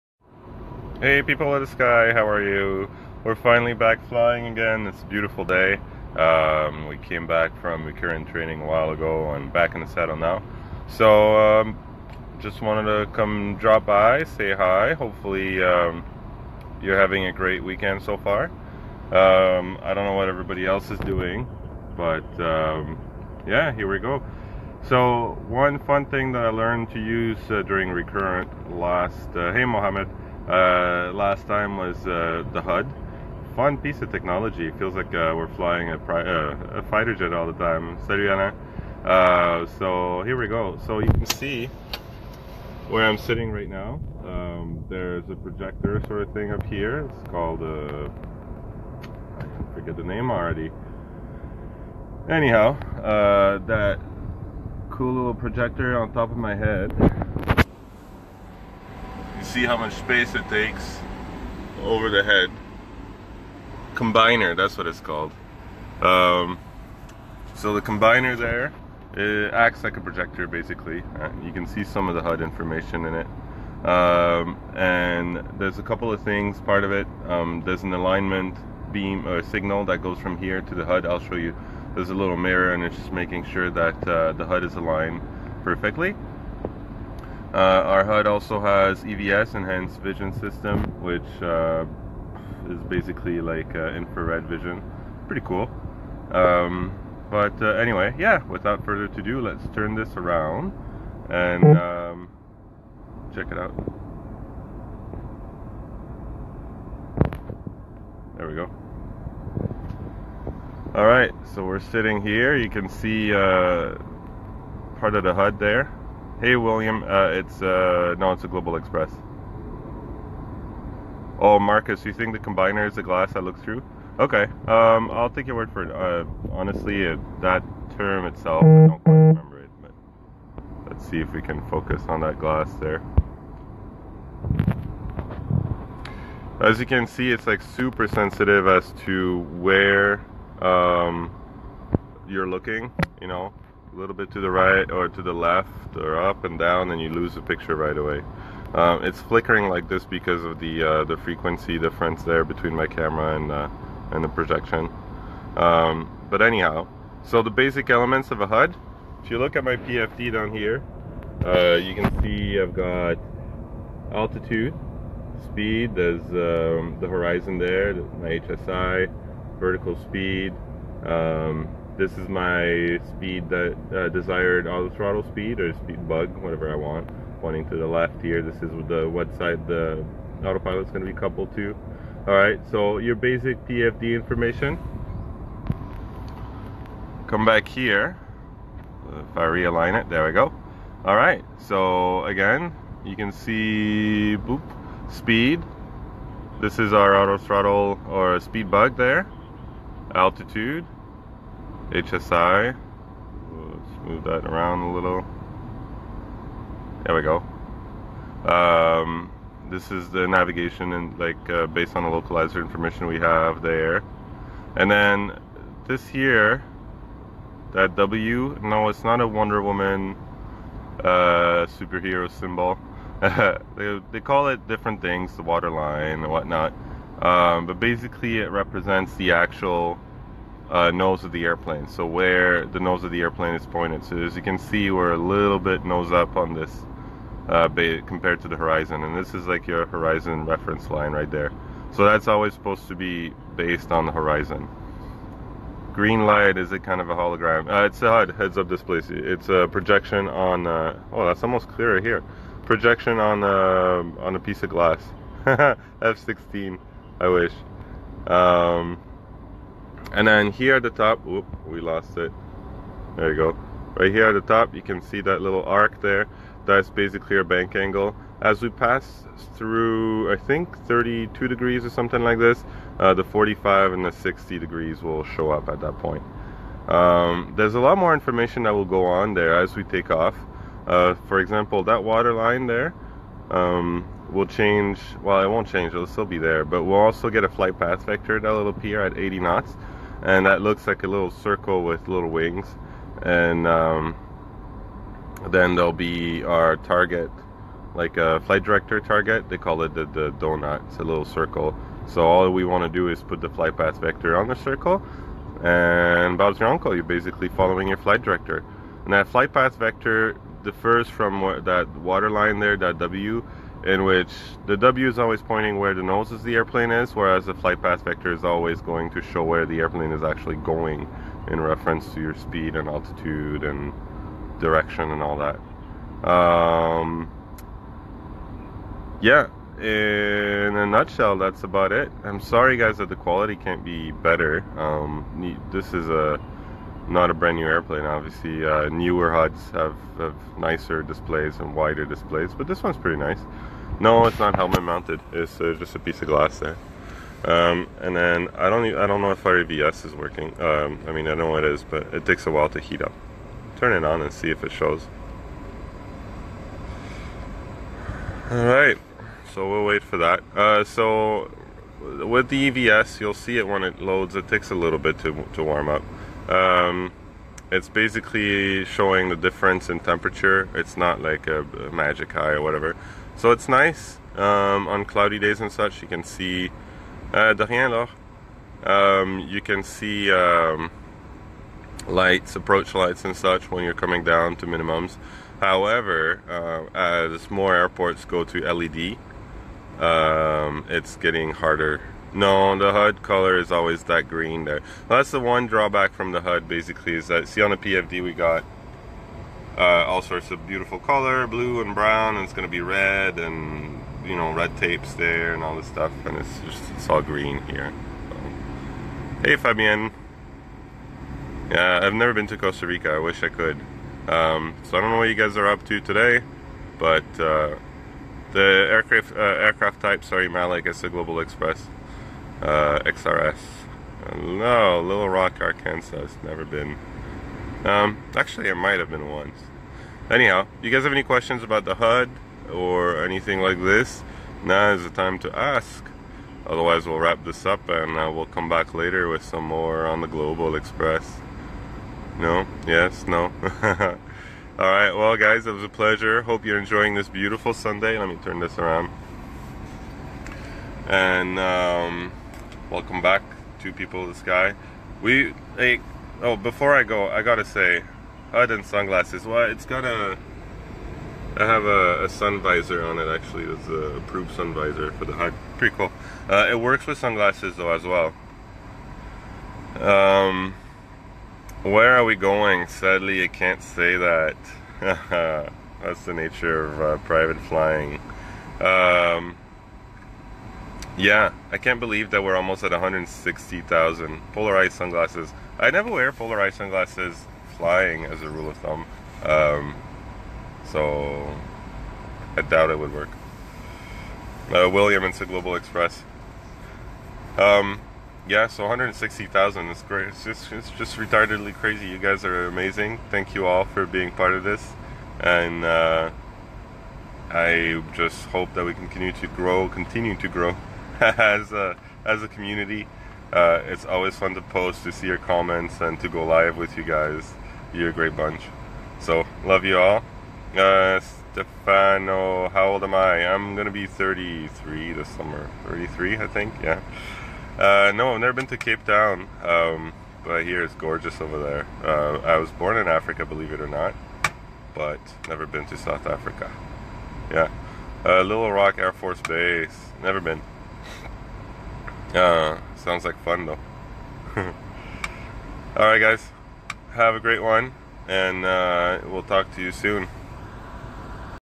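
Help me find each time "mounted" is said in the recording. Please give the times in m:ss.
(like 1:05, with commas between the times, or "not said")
5:44.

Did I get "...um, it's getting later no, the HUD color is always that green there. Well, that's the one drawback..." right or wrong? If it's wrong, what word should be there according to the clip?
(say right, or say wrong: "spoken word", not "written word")
wrong: "harder", not "later".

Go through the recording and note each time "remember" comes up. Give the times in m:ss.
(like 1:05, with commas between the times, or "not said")
2:09.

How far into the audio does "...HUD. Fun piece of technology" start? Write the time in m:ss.
0:32.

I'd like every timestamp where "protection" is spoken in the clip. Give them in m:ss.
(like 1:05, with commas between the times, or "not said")
not said.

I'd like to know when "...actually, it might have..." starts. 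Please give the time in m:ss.
7:08.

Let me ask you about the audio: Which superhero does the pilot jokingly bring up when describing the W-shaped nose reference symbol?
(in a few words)
Wonder Woman.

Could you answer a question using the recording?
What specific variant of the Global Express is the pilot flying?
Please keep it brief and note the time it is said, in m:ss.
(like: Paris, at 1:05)
XRS, at 7:03.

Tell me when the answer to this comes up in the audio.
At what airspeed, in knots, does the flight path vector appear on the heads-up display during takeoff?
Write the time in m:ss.
4:49.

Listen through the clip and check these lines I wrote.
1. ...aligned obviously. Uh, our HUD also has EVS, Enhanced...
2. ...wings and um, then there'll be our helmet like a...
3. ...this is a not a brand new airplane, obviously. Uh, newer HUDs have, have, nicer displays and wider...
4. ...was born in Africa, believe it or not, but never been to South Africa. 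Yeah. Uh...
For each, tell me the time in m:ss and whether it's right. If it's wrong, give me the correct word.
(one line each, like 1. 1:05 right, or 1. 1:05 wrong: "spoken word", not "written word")
1. 1:24 wrong: "perfectly", not "obviously"
2. 4:52 wrong: "target", not "helmet"
3. 5:35 right
4. 8:52 right.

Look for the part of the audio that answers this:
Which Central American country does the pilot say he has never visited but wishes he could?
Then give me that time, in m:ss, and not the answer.
6:52.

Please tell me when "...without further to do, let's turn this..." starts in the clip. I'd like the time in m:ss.
1:38.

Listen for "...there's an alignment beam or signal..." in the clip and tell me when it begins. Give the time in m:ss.
1:17.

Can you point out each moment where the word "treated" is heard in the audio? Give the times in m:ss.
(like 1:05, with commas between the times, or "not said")
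not said.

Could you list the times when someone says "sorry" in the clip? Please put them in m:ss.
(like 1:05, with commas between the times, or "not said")
5:32, 7:00.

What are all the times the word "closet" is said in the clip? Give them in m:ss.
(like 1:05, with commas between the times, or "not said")
not said.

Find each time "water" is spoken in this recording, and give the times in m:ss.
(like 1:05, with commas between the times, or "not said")
3:45, 4:42, 5:11.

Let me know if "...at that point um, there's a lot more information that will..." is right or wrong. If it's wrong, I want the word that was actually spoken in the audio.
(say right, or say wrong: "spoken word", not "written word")
right.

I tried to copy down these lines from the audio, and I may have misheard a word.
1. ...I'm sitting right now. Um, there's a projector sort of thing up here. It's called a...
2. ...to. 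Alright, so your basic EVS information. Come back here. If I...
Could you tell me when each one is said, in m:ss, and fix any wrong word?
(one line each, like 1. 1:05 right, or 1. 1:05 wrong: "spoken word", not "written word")
1. 0:43 right
2. 3:01 wrong: "PFD", not "EVS".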